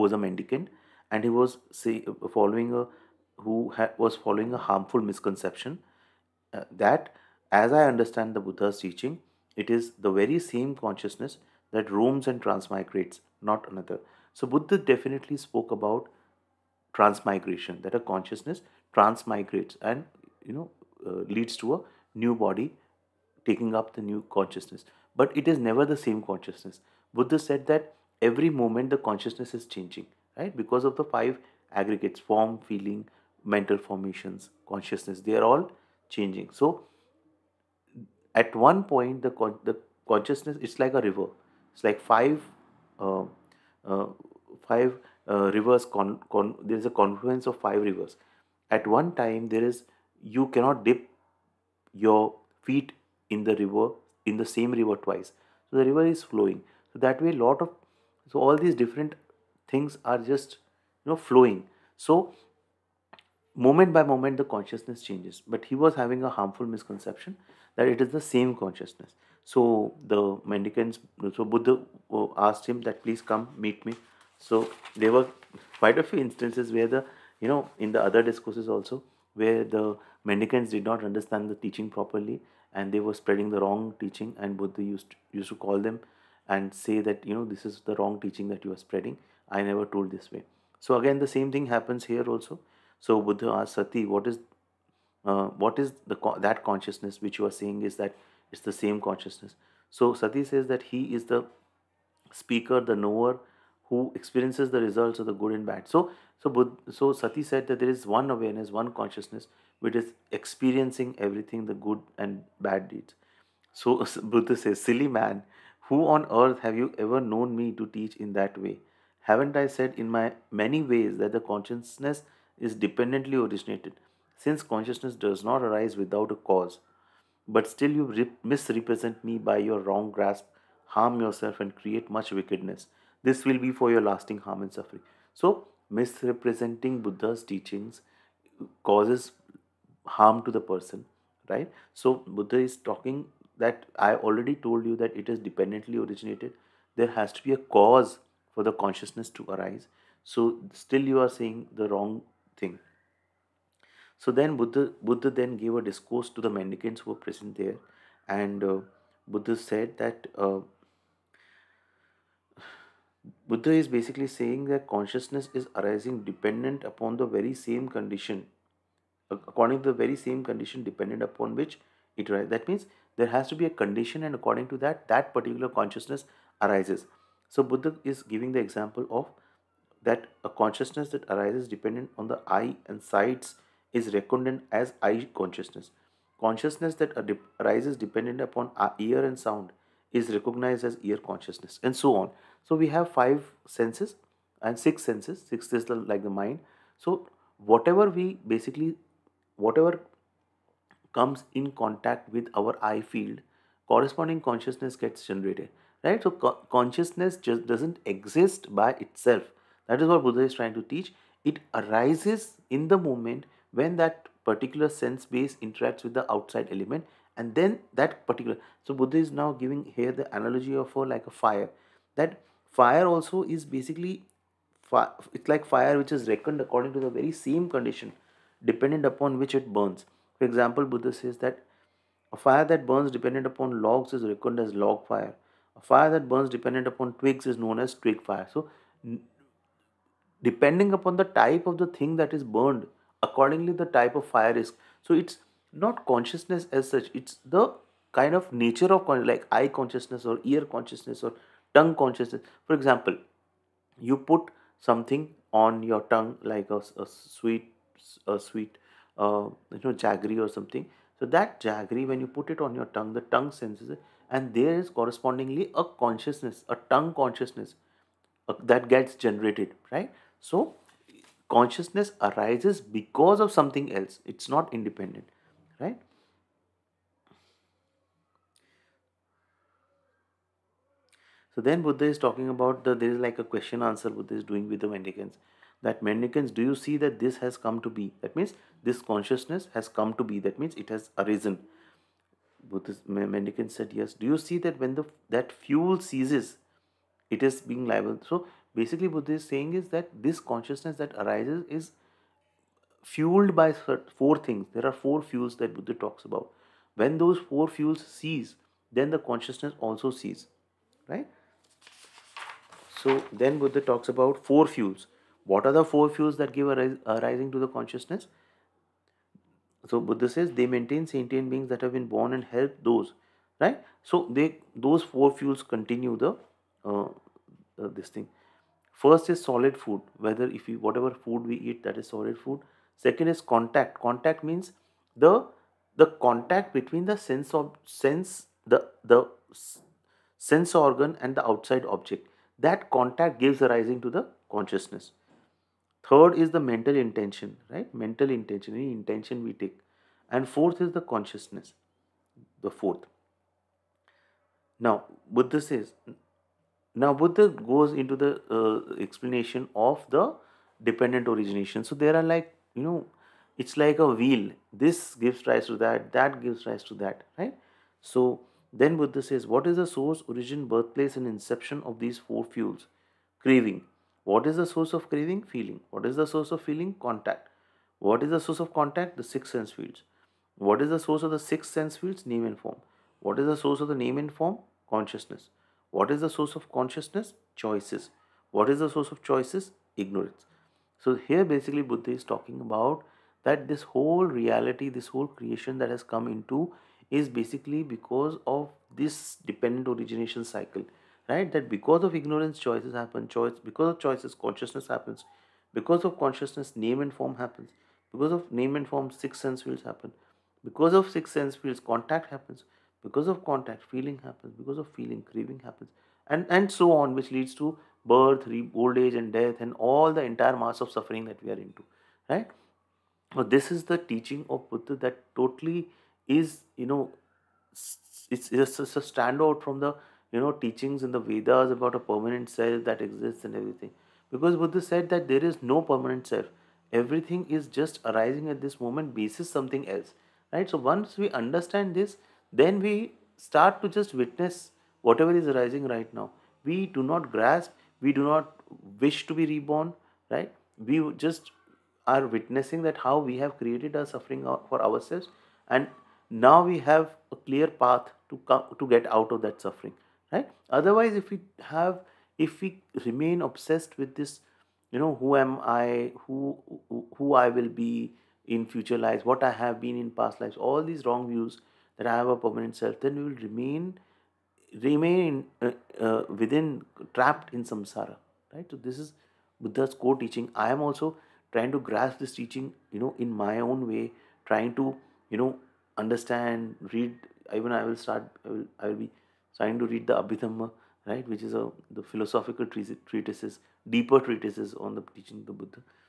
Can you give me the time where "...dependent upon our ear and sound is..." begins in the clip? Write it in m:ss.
3:07.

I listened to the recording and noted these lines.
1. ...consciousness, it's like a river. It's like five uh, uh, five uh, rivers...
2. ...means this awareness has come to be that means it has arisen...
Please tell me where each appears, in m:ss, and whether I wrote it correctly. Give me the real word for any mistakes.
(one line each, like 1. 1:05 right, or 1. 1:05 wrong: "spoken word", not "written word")
1. 0:40 right
2. 4:48 wrong: "consciousness", not "awareness".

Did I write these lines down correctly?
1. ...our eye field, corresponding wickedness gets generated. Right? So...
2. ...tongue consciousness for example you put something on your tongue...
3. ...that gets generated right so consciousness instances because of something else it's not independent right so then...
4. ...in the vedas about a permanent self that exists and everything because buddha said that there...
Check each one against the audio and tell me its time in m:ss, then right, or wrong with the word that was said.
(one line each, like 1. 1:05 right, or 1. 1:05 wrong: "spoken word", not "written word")
1. 3:22 wrong: "consciousness", not "wickedness"
2. 4:11 right
3. 4:28 wrong: "arises", not "instances"
4. 7:11 right.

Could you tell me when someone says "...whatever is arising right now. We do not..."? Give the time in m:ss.
7:25.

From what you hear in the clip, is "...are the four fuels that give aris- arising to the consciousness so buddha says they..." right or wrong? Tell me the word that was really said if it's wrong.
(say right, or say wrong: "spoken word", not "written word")
right.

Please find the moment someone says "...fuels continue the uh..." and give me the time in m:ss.
5:25.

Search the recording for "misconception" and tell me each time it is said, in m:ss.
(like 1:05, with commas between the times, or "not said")
0:05, 1:06.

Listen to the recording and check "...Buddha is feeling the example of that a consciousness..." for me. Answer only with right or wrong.
wrong.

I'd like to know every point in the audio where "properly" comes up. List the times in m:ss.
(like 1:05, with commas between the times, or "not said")
1:21.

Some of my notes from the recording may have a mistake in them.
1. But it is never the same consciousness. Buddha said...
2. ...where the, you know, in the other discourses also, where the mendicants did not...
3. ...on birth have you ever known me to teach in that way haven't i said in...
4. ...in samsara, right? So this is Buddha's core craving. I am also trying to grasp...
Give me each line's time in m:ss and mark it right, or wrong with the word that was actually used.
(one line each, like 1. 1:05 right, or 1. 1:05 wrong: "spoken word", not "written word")
1. 0:25 right
2. 1:16 right
3. 1:56 wrong: "earth", not "birth"
4. 7:57 wrong: "teaching", not "craving".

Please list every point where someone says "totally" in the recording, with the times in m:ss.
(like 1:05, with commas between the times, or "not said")
7:05.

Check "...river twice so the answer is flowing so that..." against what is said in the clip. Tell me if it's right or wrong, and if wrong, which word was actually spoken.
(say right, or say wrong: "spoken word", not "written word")
wrong: "river", not "answer".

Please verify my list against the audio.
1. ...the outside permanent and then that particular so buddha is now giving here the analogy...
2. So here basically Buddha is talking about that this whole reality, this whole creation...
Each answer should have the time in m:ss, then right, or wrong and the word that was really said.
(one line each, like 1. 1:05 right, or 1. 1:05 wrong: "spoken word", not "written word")
1. 3:36 wrong: "element", not "permanent"
2. 6:30 right.